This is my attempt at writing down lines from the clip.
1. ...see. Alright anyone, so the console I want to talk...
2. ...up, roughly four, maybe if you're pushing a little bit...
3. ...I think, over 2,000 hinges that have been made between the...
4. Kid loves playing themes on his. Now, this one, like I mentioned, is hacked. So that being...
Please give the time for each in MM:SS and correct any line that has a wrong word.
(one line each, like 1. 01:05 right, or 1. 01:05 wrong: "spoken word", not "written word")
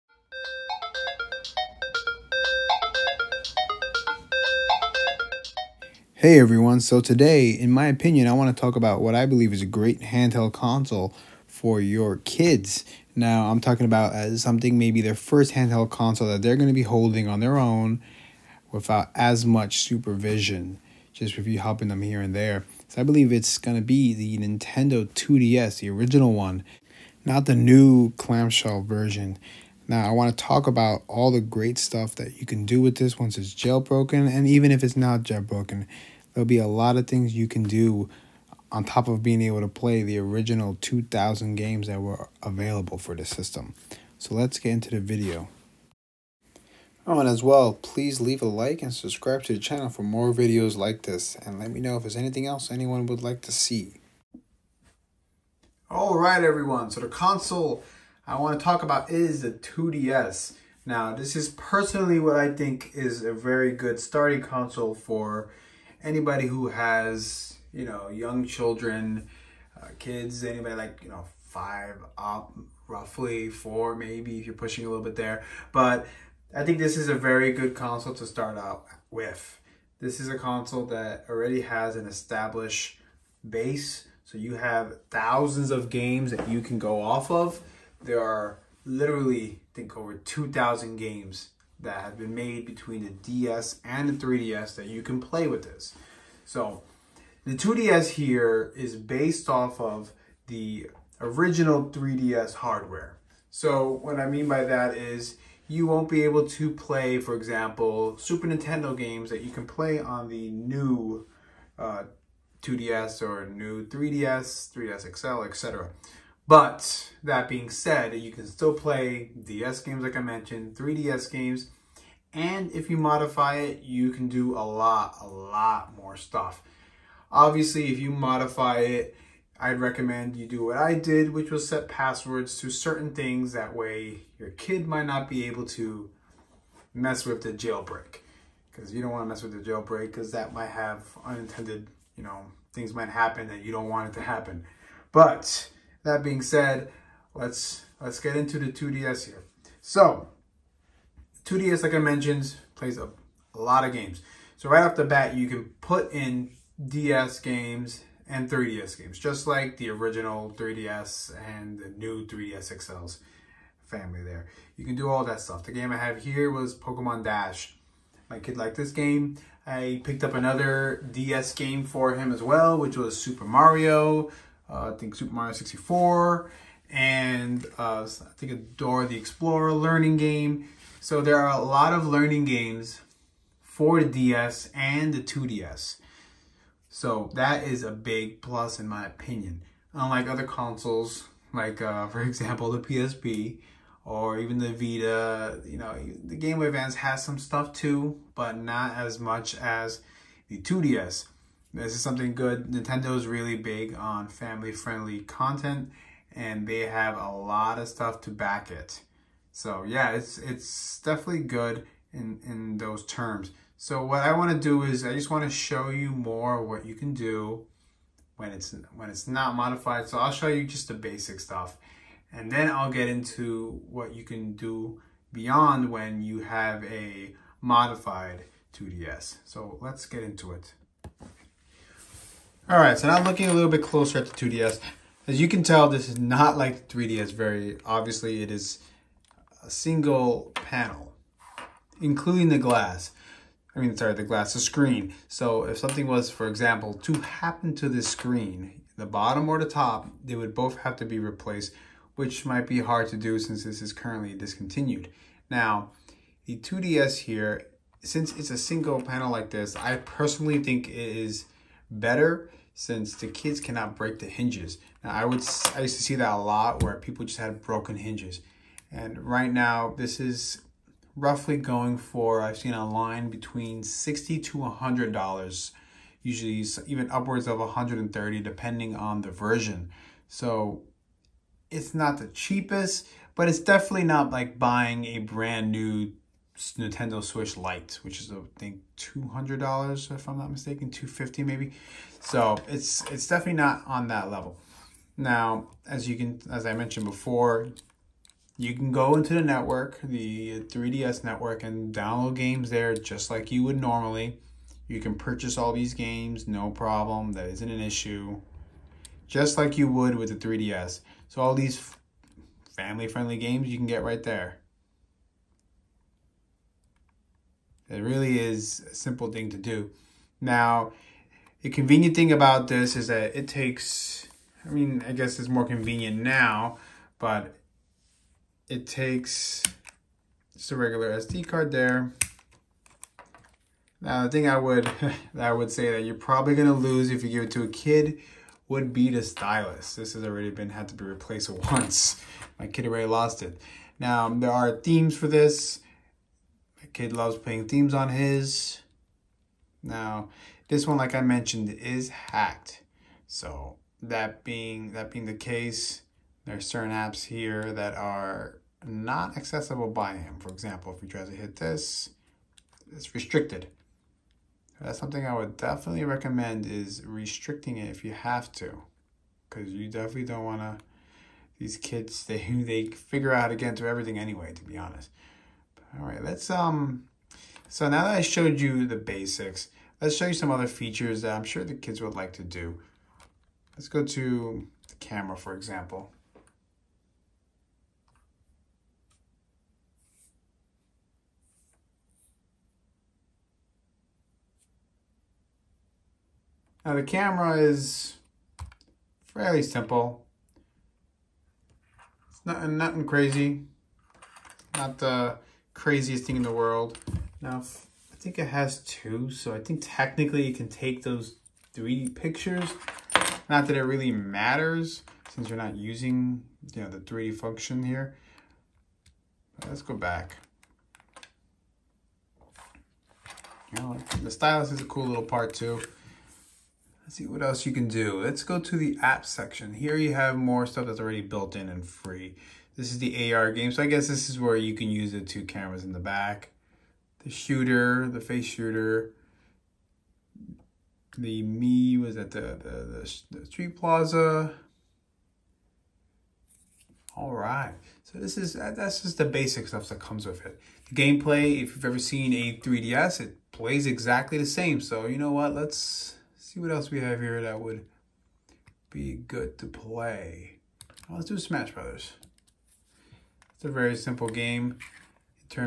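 1. 00:53 wrong: "everyone", not "anyone"
2. 01:12 right
3. 01:29 wrong: "games", not "hinges"
4. 05:46 right.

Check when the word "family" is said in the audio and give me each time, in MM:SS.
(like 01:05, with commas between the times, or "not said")
02:43, 03:24, 05:12.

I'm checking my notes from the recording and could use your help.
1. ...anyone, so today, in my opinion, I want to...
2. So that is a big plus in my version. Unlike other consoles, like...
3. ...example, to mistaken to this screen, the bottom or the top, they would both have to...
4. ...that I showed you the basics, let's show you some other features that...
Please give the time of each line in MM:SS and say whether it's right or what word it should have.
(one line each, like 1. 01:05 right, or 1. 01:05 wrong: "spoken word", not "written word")
1. 00:06 wrong: "everyone", not "anyone"
2. 03:06 wrong: "opinion", not "version"
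3. 04:06 wrong: "happen", not "mistaken"
4. 06:18 right.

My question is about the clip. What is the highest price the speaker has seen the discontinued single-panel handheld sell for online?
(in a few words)
$130.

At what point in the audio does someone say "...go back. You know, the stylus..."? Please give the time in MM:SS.
06:59.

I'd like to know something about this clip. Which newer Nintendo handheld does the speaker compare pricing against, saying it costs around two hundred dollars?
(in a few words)
Nintendo Switch Lite.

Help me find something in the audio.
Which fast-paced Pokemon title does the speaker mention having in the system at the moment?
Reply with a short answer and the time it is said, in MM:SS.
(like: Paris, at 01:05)
Pokemon Dash, at 02:46.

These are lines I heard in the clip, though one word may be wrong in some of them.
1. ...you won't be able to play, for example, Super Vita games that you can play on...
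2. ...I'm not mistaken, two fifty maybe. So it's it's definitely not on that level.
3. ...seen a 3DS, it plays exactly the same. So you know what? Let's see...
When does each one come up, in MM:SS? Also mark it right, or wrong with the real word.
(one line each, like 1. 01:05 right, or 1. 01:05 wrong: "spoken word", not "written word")
1. 01:45 wrong: "Nintendo", not "Vita"
2. 04:50 right
3. 07:31 right.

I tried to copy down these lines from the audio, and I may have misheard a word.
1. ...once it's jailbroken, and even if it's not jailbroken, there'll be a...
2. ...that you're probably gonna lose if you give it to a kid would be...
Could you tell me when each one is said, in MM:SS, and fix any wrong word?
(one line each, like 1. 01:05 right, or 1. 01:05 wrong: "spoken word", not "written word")
1. 00:33 right
2. 05:35 right.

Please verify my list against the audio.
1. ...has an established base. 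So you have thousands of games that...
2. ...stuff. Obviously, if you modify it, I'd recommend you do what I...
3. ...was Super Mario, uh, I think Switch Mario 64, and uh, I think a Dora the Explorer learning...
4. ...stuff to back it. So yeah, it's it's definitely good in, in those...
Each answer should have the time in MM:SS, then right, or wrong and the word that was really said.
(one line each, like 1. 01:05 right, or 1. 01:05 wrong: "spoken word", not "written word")
1. 01:21 right
2. 02:06 right
3. 02:52 wrong: "Super", not "Switch"
4. 03:27 right.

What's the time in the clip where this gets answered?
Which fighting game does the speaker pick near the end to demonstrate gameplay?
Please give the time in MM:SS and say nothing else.
07:41.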